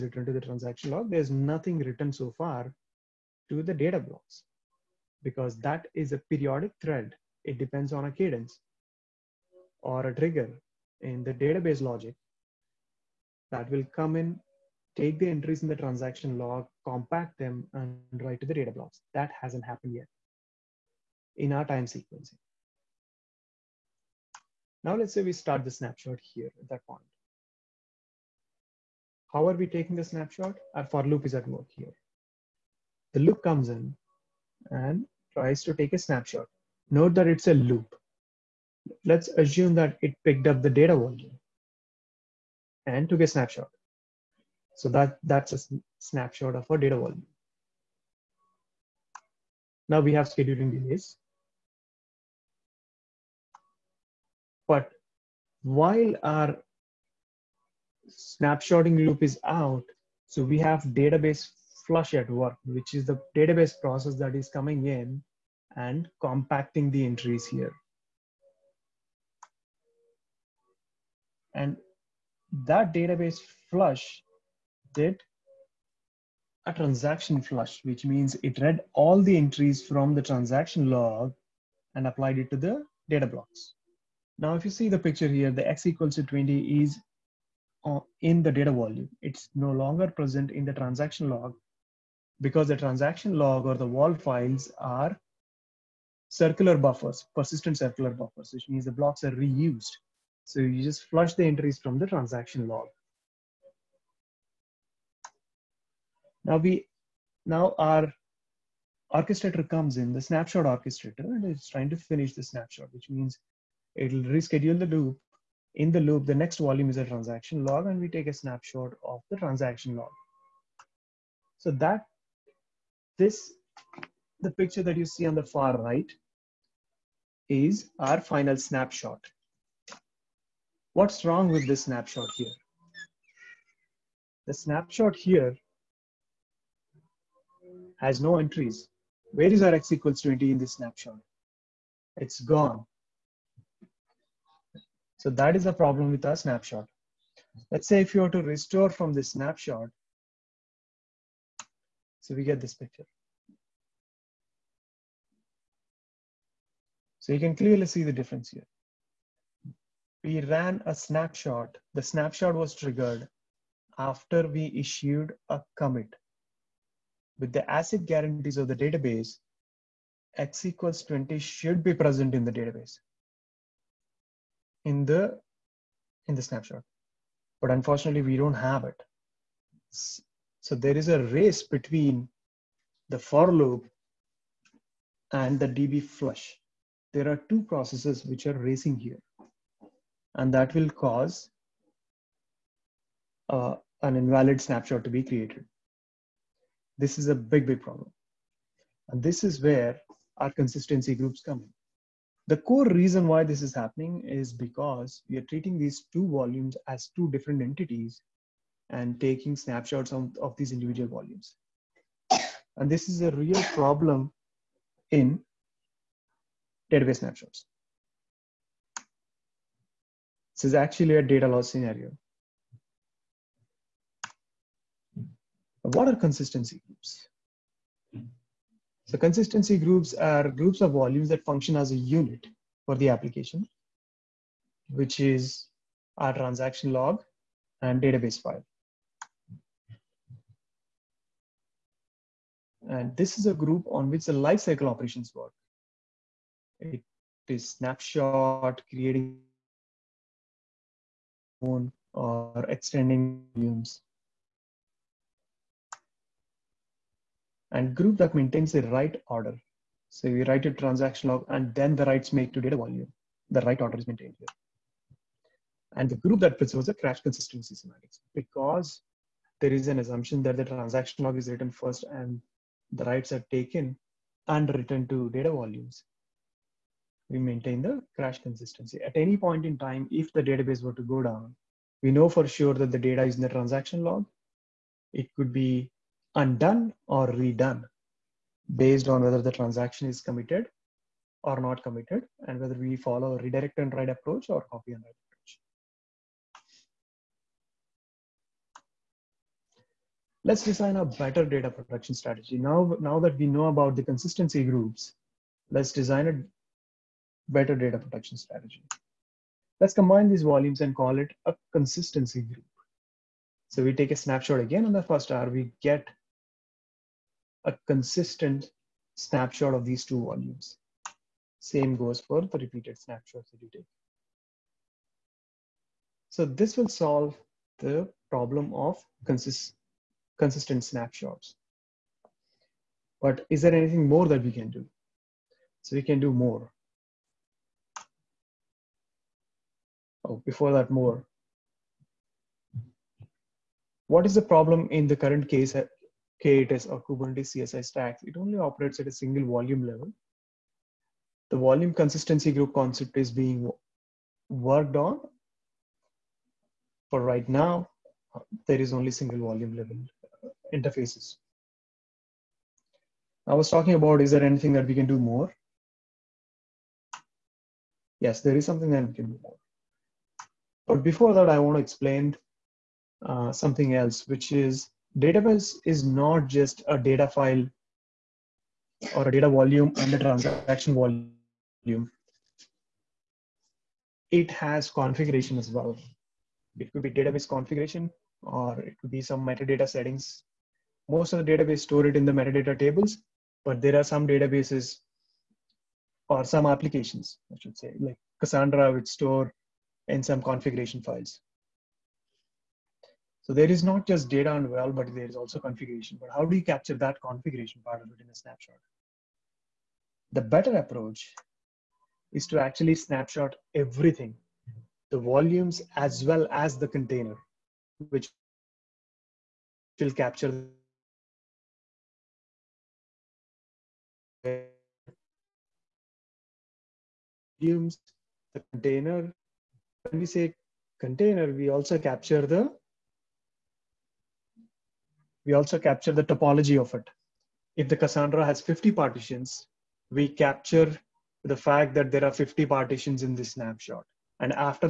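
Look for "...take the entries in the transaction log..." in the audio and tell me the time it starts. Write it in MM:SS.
00:14.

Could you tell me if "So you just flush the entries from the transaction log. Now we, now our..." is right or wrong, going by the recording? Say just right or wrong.
right.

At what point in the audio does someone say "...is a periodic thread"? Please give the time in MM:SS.
00:05.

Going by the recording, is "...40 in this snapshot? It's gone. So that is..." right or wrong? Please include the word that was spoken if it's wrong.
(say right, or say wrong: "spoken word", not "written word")
wrong: "20", not "40".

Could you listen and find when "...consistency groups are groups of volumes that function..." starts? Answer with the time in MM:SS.
03:49.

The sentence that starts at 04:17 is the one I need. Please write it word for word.
And group that maintains the right order.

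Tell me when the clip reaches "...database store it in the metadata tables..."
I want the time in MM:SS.
06:31.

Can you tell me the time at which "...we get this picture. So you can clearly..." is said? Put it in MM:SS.
02:32.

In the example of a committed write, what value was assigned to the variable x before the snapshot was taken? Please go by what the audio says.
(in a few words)
20.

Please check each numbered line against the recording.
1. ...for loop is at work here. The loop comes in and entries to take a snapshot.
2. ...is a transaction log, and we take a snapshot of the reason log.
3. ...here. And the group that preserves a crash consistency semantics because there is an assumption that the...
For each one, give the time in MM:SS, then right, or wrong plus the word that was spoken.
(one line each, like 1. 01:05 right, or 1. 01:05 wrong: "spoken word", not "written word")
1. 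00:30 wrong: "tries", not "entries"
2. 01:56 wrong: "transaction", not "reason"
3. 04:24 right.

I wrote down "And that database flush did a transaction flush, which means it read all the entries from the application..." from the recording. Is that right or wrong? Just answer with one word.
wrong.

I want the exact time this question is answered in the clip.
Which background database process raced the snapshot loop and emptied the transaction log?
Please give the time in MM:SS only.
03:05.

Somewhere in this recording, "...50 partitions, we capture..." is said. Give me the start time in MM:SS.
07:18.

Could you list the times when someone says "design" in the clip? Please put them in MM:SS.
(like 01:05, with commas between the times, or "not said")
05:00, 05:05.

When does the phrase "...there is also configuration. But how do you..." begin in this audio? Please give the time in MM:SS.
06:45.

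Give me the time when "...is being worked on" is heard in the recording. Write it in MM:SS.
05:53.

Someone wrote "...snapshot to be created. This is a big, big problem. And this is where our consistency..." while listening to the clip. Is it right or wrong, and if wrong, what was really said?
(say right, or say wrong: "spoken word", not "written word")
right.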